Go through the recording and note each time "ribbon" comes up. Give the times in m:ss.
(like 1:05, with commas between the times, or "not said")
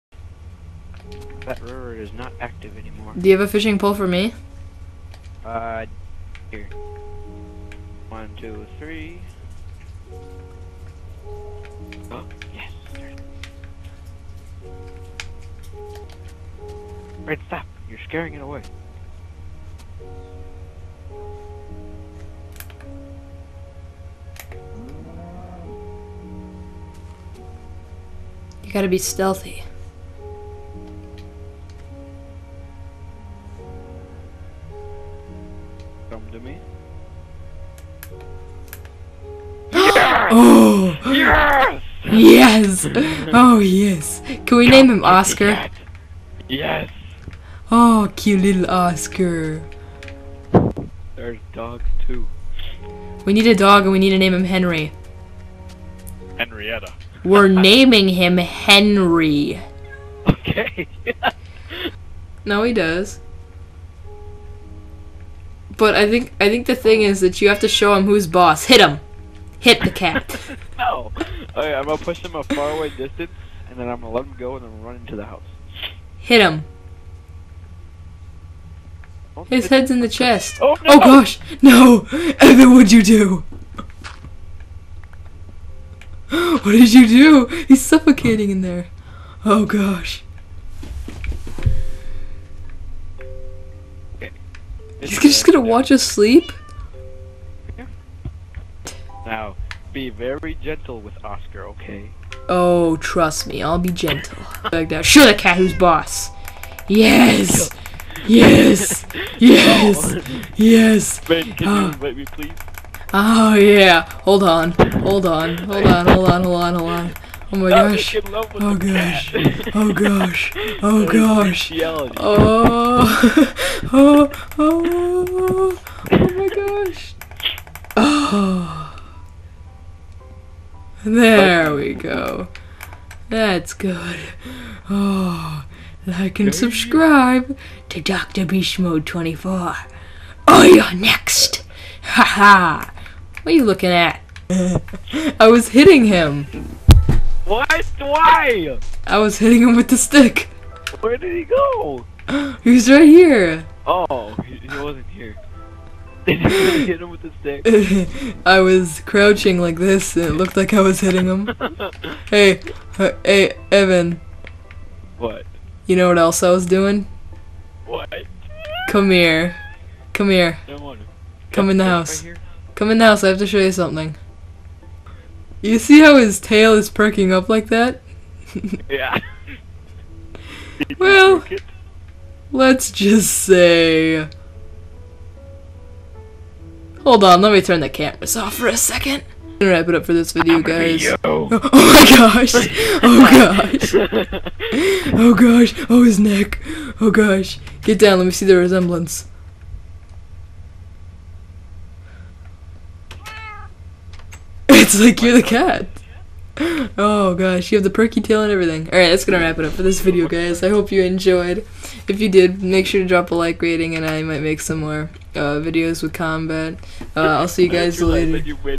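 not said.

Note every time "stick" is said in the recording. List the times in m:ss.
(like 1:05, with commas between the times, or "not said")
2:29, 2:37.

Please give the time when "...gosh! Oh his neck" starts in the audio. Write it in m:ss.
3:15.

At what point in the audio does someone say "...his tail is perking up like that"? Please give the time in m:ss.
2:56.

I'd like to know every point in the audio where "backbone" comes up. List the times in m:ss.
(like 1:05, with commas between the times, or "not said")
not said.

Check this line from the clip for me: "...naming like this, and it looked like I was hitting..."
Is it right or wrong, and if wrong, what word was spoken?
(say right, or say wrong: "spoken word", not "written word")
wrong: "crouching", not "naming".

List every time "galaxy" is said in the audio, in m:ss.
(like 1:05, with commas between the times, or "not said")
not said.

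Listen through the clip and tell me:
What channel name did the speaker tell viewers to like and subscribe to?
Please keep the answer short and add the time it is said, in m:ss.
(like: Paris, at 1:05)
Dr. Beast 24, at 2:17.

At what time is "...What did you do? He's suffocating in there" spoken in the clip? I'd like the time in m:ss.
1:26.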